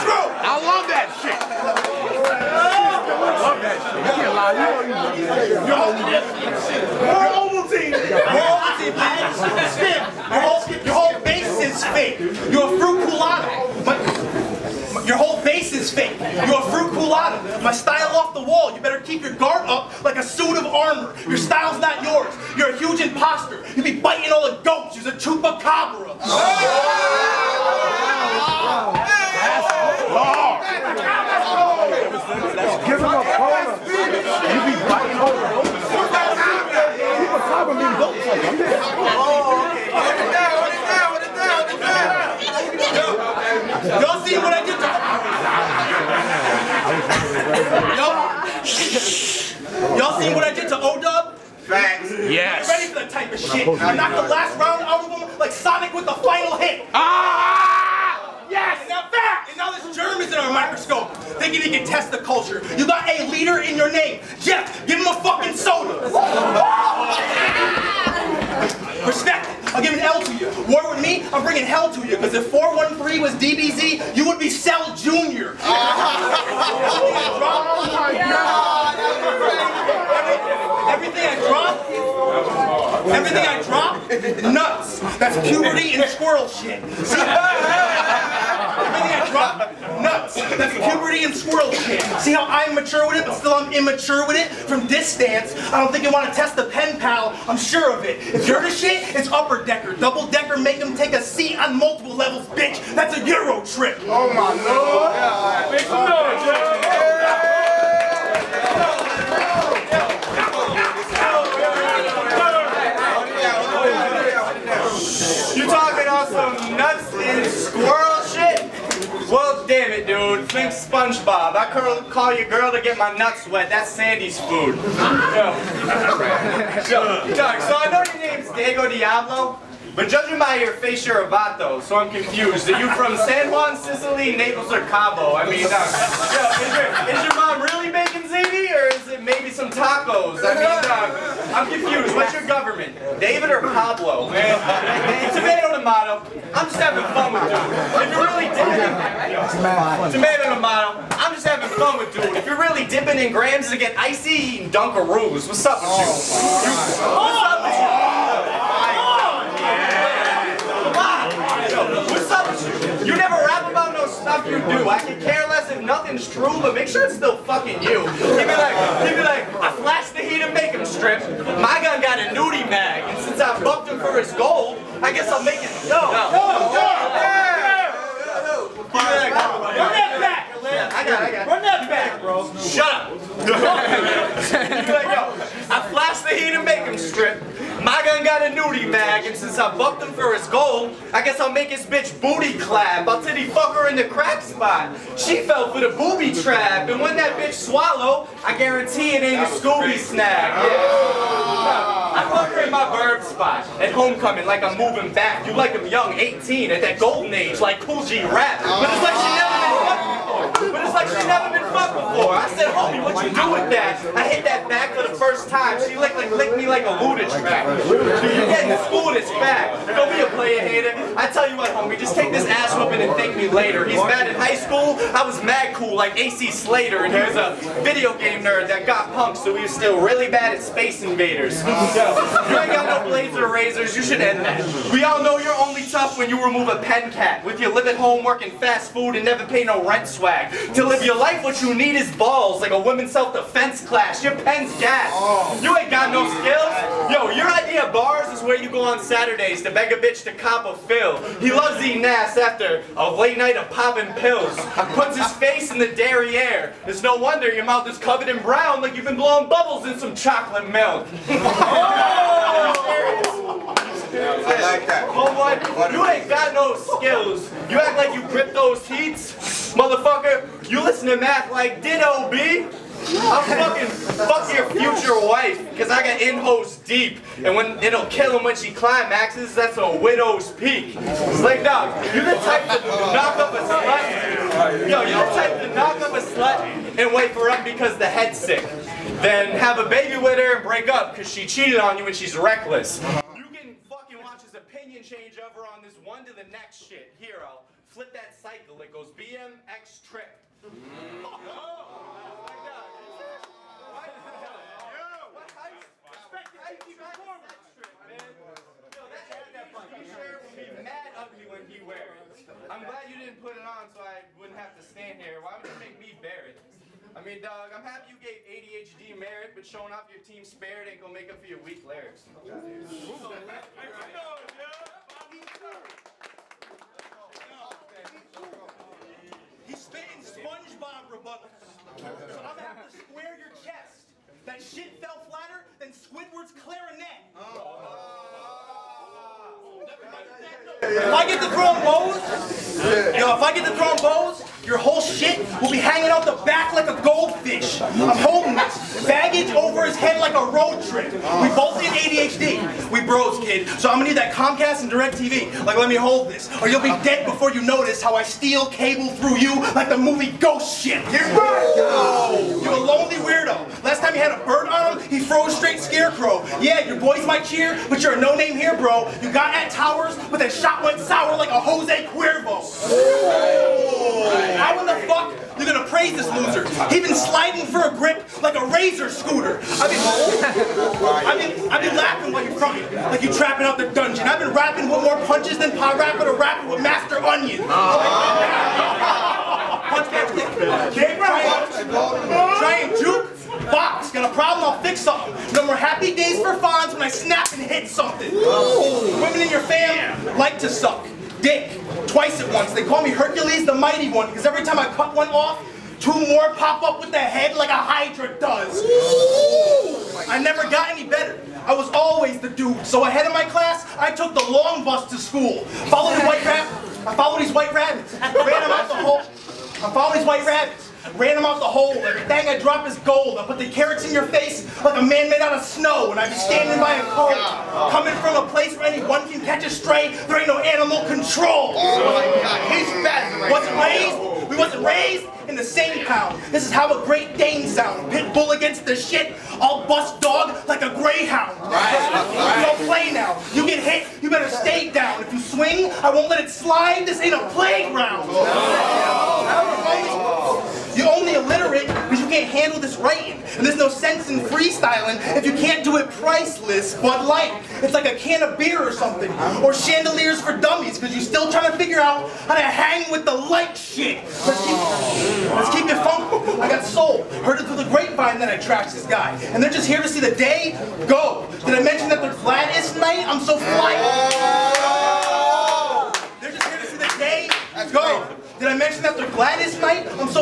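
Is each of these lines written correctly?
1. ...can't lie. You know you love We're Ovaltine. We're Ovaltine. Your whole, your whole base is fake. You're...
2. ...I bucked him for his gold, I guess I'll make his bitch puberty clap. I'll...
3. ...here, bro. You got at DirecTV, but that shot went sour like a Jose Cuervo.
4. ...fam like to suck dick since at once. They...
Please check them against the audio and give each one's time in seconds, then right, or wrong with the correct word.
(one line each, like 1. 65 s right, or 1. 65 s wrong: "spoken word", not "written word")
1. 4 s right
2. 189 s wrong: "booty", not "puberty"
3. 368 s wrong: "Towers", not "DirecTV"
4. 399 s wrong: "twice", not "since".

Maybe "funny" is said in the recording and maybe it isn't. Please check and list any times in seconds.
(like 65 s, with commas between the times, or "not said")
not said.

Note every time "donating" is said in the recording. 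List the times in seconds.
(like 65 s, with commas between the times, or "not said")
not said.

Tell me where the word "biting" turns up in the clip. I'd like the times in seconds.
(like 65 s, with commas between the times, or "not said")
23 s, 34 s.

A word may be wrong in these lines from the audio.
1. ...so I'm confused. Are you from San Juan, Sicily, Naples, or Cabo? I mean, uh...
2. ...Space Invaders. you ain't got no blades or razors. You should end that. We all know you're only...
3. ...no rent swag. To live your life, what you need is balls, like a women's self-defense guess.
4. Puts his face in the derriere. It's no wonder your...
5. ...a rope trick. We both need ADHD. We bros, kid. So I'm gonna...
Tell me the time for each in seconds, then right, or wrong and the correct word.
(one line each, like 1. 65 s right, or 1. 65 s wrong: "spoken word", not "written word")
1. 131 s right
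2. 230 s right
3. 239 s wrong: "class", not "guess"
4. 254 s right
5. 350 s right.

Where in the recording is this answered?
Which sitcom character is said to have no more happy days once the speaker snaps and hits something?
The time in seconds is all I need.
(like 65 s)
396 s.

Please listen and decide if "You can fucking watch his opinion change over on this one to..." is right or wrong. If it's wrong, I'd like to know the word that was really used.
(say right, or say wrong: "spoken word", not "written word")
right.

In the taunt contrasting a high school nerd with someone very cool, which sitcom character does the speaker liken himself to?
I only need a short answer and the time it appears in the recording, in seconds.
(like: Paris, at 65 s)
AC Slater, at 226 s.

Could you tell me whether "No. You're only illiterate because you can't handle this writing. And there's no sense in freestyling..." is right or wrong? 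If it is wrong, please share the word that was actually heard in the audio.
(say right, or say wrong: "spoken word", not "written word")
right.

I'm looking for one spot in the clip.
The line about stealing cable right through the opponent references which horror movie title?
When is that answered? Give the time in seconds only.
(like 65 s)
360 s.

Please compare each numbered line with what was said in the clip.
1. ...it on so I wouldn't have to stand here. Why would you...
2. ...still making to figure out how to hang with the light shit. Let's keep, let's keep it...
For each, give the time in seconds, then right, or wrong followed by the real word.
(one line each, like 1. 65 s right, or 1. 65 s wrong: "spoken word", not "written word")
1. 313 s right
2. 461 s wrong: "trying", not "making".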